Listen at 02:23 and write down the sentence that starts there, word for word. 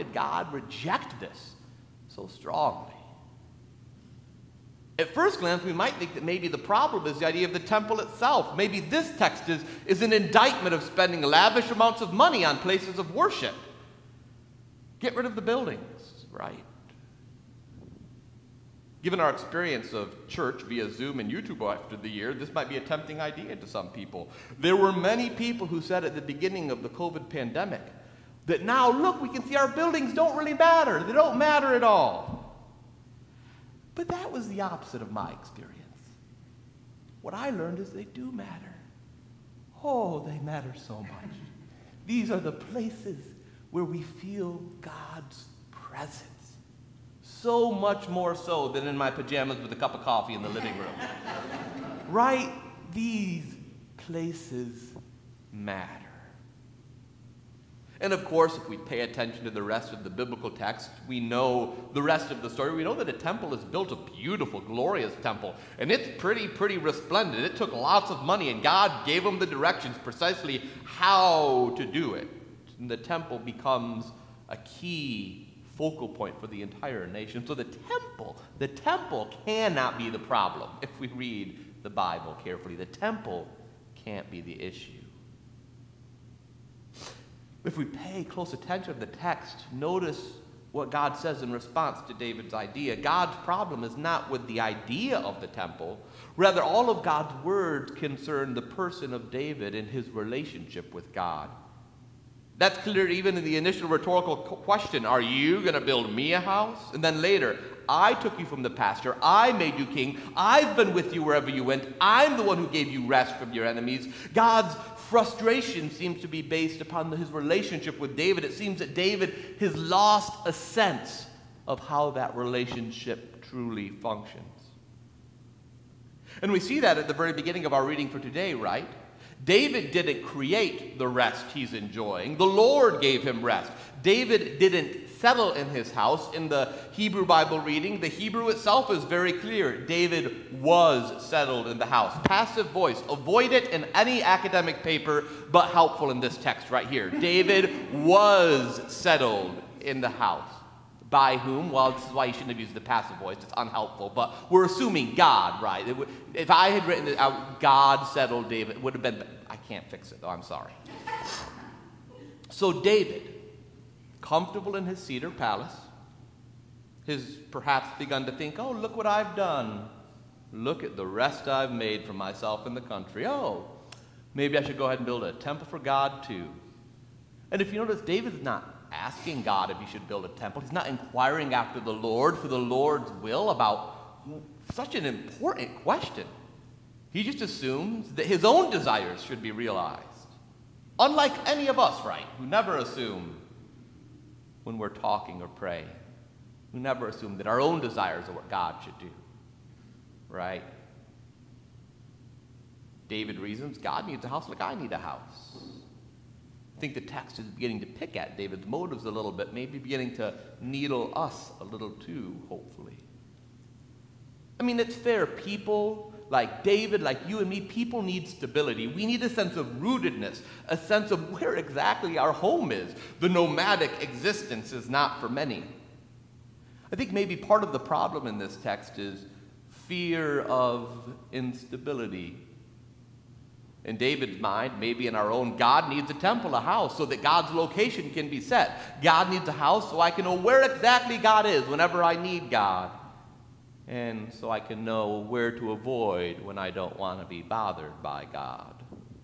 Avoid it in any academic paper, but helpful in this text right here.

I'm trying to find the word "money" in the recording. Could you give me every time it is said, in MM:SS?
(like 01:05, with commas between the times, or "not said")
00:12, 01:08.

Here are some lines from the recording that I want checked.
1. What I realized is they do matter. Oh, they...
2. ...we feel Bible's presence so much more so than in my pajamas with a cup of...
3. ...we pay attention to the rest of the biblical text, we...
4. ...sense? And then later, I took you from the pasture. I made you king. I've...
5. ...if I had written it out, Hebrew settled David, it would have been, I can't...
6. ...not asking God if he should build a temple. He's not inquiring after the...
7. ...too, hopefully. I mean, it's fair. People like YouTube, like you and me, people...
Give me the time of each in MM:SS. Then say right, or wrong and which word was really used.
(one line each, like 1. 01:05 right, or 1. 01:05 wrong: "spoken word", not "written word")
1. 00:37 wrong: "learned", not "realized"
2. 00:43 wrong: "God", not "Bible"
3. 00:58 right
4. 01:46 wrong: "house", not "sense"
5. 02:36 wrong: "God", not "Hebrew"
6. 02:58 right
7. 03:31 wrong: "David", not "YouTube".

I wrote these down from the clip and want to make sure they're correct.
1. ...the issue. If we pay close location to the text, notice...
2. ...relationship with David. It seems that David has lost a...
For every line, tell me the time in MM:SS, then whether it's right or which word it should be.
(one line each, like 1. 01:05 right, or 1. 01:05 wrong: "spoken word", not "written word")
1. 01:24 wrong: "attention", not "location"
2. 01:57 right.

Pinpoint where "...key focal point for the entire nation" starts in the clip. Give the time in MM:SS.
01:14.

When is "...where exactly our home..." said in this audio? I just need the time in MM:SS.
03:41.